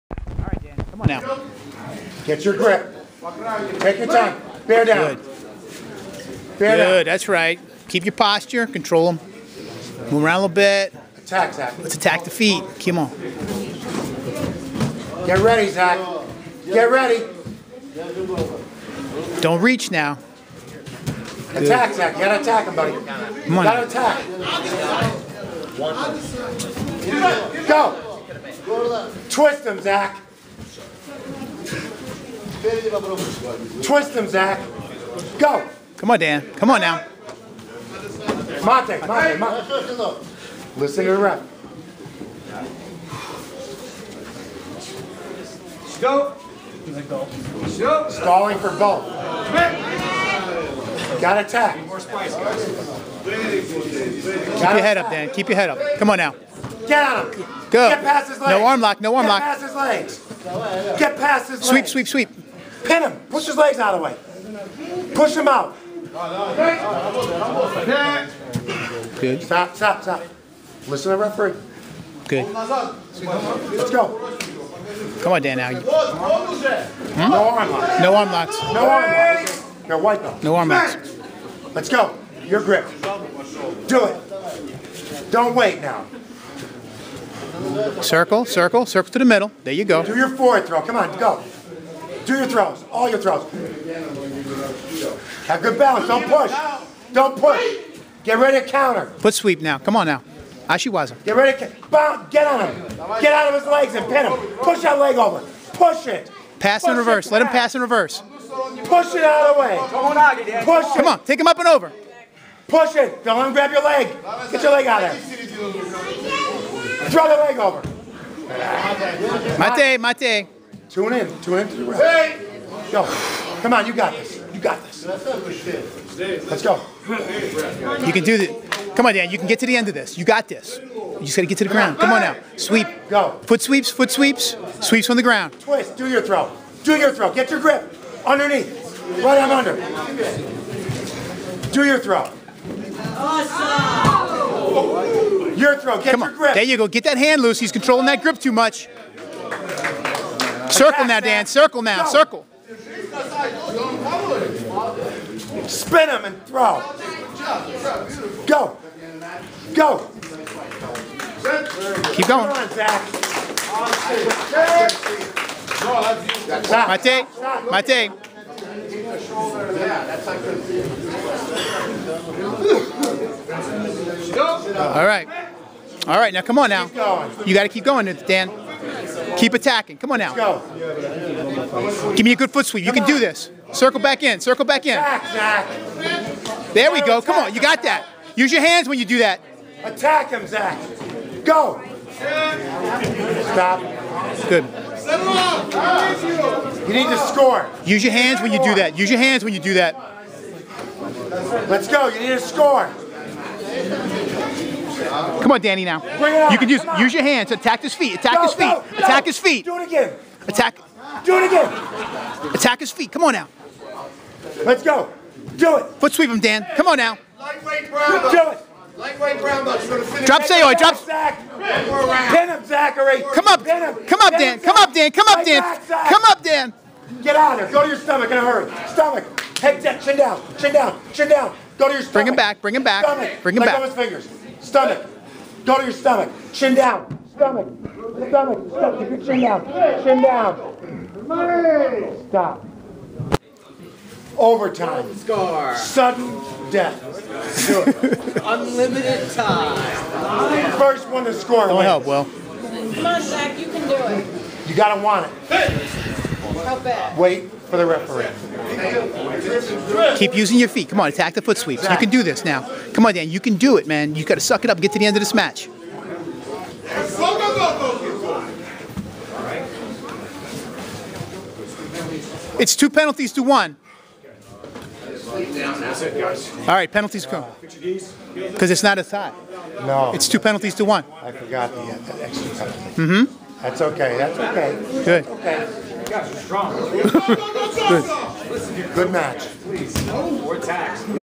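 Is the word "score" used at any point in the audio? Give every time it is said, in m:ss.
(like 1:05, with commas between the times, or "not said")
3:17, 3:22, 4:05, 4:11.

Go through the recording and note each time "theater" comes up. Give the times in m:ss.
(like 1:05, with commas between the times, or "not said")
not said.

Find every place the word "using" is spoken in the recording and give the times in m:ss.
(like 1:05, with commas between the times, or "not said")
4:20.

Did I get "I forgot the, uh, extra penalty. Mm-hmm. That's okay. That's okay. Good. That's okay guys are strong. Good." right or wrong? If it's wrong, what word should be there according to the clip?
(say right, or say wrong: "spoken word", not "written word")
right.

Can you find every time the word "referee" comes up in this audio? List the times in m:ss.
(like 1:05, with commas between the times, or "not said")
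1:11, 4:17.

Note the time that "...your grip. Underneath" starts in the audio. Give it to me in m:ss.
2:17.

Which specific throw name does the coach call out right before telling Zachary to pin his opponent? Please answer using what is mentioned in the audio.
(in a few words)
Drop Seoi.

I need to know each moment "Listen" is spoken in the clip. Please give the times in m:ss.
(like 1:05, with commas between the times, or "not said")
0:40, 1:10.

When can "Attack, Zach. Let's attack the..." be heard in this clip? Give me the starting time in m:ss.
0:11.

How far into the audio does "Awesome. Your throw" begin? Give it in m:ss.
2:23.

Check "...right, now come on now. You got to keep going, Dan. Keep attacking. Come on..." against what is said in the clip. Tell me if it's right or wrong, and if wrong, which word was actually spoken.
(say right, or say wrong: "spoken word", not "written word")
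right.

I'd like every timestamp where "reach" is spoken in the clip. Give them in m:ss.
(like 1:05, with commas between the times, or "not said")
0:19.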